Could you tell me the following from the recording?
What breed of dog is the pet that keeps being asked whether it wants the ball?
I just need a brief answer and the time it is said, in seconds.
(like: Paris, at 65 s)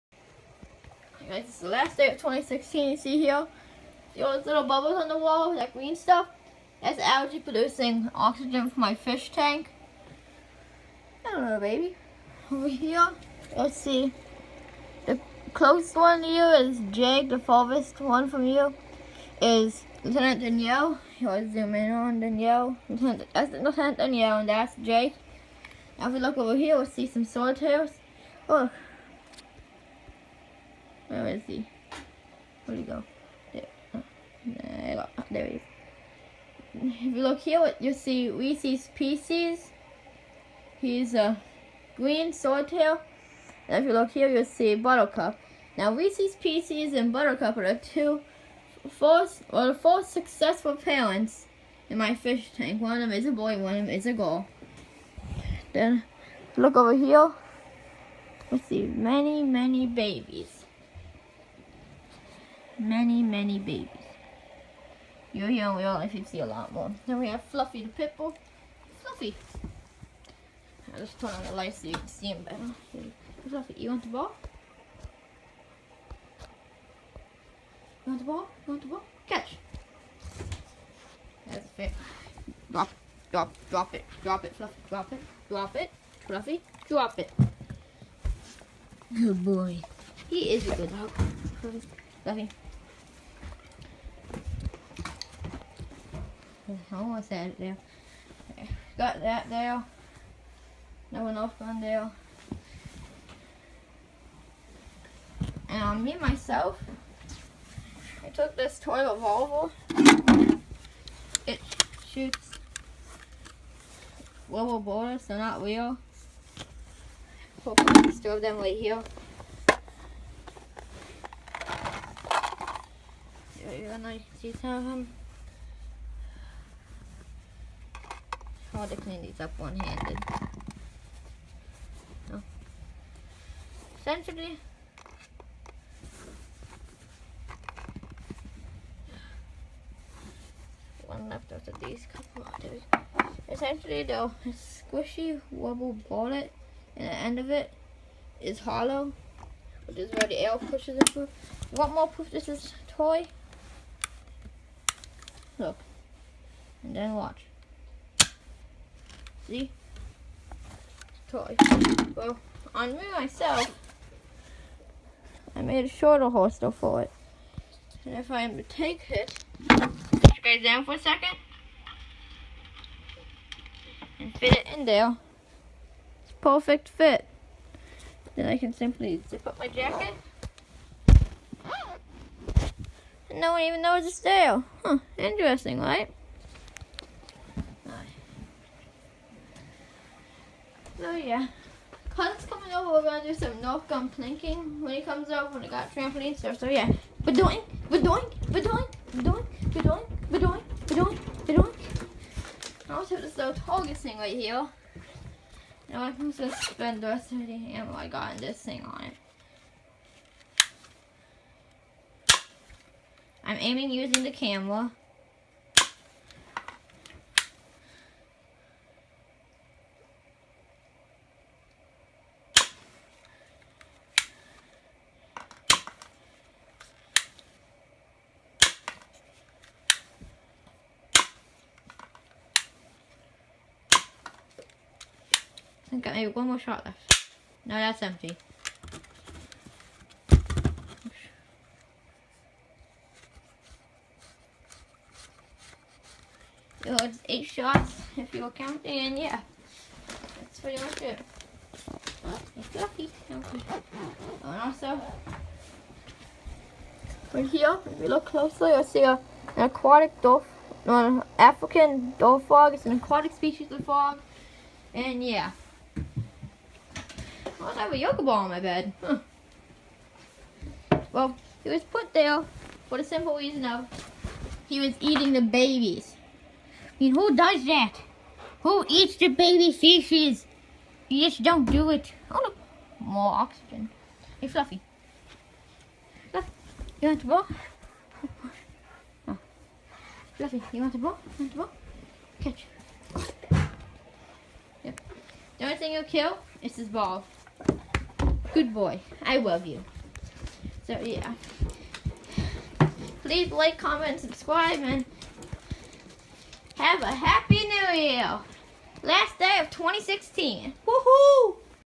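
Pitbull, at 68 s.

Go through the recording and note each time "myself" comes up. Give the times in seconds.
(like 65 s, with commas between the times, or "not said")
106 s, 163 s.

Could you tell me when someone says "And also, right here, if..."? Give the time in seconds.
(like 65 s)
254 s.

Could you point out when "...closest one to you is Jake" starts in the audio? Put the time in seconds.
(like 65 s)
15 s.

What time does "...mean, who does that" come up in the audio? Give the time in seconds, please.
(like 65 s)
277 s.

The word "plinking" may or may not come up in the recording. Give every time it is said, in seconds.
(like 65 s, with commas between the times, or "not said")
194 s.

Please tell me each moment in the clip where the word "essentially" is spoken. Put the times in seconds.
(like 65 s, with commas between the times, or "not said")
134 s, 143 s.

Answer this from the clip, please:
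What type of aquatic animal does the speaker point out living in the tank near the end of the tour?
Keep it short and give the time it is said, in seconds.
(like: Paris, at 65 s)
African dwarf frog, at 261 s.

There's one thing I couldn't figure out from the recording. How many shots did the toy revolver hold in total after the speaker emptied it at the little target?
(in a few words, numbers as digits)
8.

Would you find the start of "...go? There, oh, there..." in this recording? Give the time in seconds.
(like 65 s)
32 s.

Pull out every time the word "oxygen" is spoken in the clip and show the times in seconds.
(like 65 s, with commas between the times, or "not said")
8 s, 283 s.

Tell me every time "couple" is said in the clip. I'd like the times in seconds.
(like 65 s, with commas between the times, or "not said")
142 s.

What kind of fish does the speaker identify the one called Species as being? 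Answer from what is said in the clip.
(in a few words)
green swordtail.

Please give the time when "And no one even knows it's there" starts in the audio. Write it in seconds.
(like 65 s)
183 s.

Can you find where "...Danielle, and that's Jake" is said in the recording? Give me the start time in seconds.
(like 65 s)
23 s.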